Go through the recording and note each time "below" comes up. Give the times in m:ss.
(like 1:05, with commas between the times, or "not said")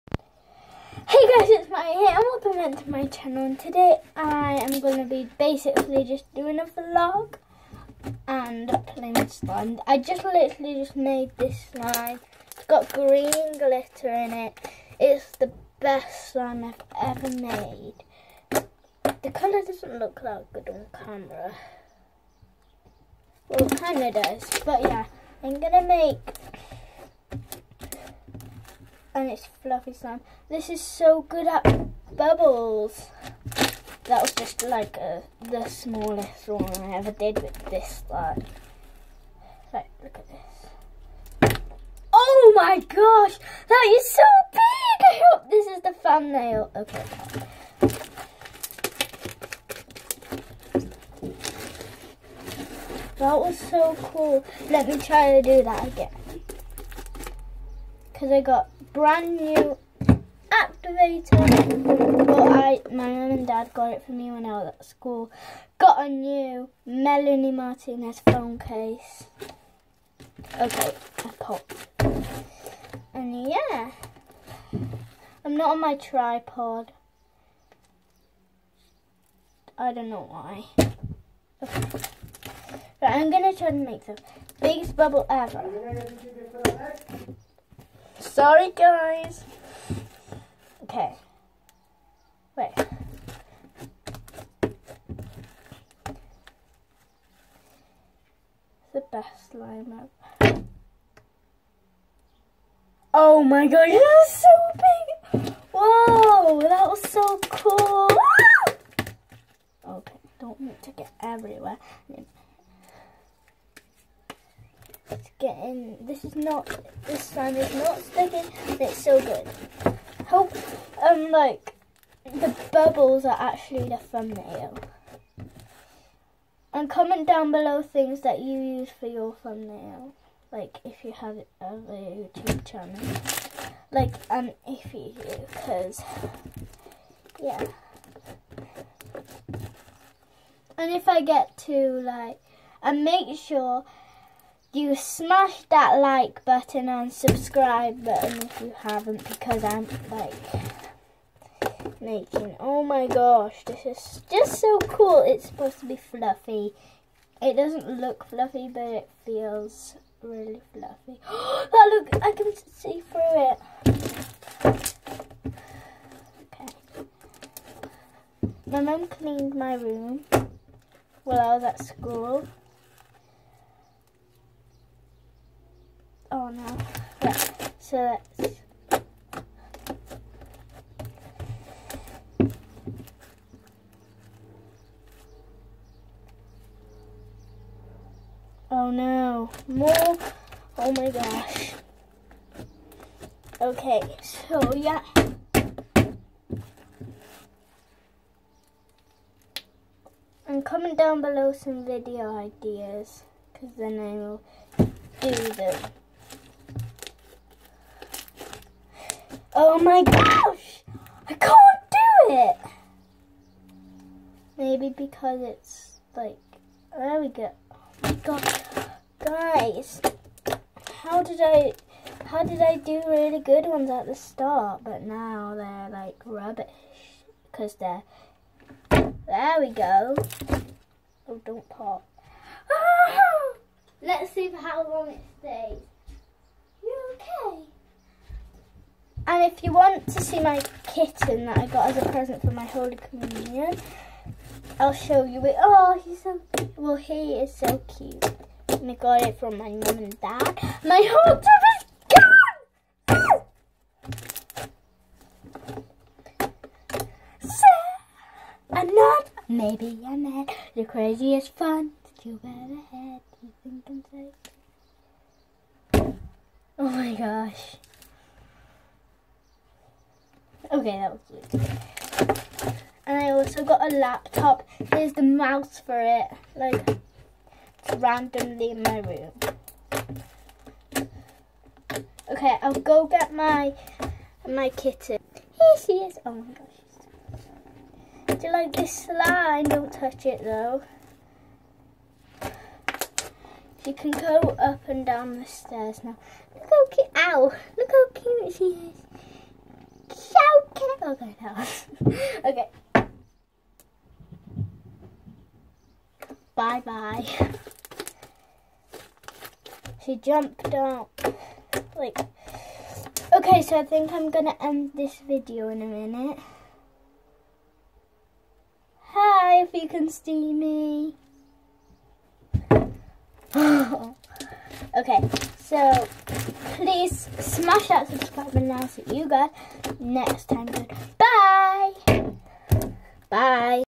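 2:07, 3:21.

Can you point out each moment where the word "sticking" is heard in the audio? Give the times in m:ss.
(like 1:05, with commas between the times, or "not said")
1:57.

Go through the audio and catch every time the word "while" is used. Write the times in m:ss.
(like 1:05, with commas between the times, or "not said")
2:51.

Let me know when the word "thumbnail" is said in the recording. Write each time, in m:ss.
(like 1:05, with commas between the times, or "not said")
0:46, 2:03, 2:09.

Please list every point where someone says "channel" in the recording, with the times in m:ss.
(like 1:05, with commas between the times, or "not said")
0:03, 2:12.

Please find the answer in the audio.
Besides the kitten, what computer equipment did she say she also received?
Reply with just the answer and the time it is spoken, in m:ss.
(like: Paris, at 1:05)
Laptop, at 4:33.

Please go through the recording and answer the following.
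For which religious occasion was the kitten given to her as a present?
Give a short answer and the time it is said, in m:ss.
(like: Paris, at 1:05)
Holy Communion, at 4:02.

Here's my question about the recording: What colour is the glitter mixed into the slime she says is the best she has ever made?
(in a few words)
Green.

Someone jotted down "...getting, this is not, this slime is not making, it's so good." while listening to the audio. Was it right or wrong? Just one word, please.
wrong.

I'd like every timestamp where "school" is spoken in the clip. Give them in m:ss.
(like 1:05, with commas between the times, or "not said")
1:04, 2:51.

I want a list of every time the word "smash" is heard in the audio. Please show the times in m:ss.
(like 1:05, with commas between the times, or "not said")
2:24, 5:27.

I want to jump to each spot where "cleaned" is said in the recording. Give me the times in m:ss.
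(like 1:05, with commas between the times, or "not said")
2:49.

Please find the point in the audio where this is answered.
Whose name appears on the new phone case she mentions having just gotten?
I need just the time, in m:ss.
1:06.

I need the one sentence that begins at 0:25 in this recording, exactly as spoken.
I'm going to make and it's fluffy slime.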